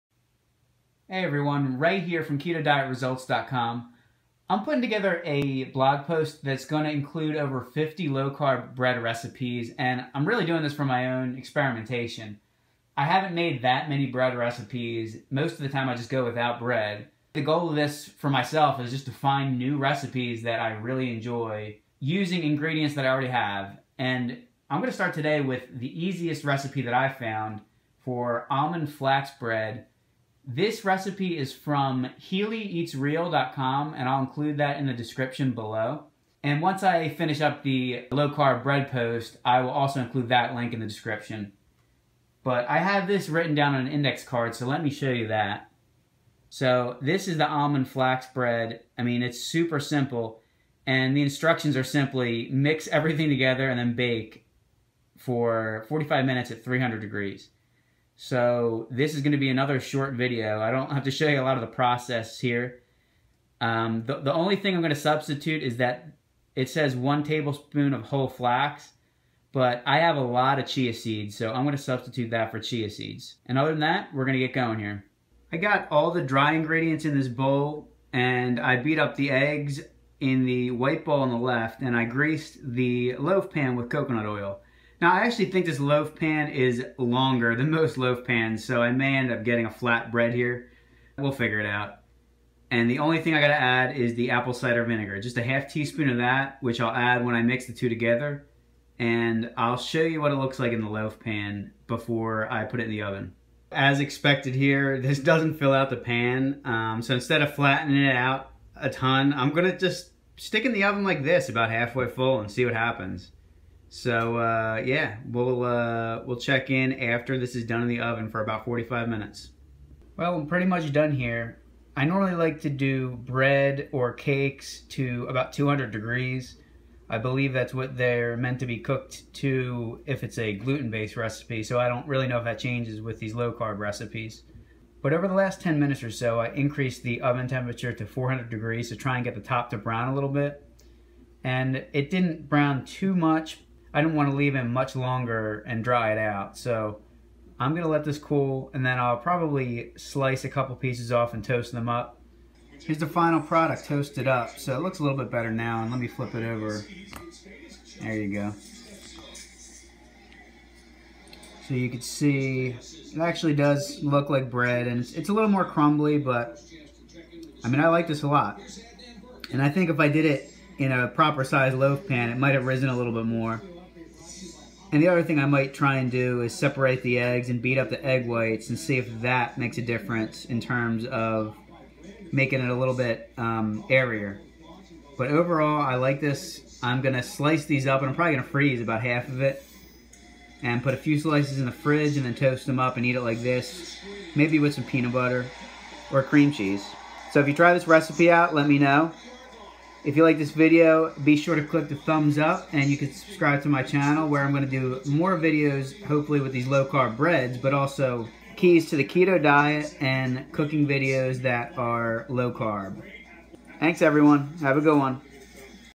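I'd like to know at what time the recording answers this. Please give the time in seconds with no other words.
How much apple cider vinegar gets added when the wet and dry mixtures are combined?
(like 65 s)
95 s.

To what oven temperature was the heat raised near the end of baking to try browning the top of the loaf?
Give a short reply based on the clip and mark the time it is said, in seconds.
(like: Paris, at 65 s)
400 degrees, at 138 s.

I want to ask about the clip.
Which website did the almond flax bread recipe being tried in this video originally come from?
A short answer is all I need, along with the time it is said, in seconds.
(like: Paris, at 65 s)
HealyEatsReal.com, at 32 s.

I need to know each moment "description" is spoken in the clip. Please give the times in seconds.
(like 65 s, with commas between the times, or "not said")
34 s, 40 s.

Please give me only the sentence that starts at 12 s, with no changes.
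I haven't made that many bread recipes.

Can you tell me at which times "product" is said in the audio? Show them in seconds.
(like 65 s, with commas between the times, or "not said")
153 s.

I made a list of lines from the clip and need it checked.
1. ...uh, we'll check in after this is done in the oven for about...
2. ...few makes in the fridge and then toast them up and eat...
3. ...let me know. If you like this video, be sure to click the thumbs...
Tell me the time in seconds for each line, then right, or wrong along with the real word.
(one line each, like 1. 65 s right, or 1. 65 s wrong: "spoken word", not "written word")
1. 115 s right
2. 190 s wrong: "slices", not "makes"
3. 198 s right.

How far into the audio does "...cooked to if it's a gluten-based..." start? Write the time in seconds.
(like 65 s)
128 s.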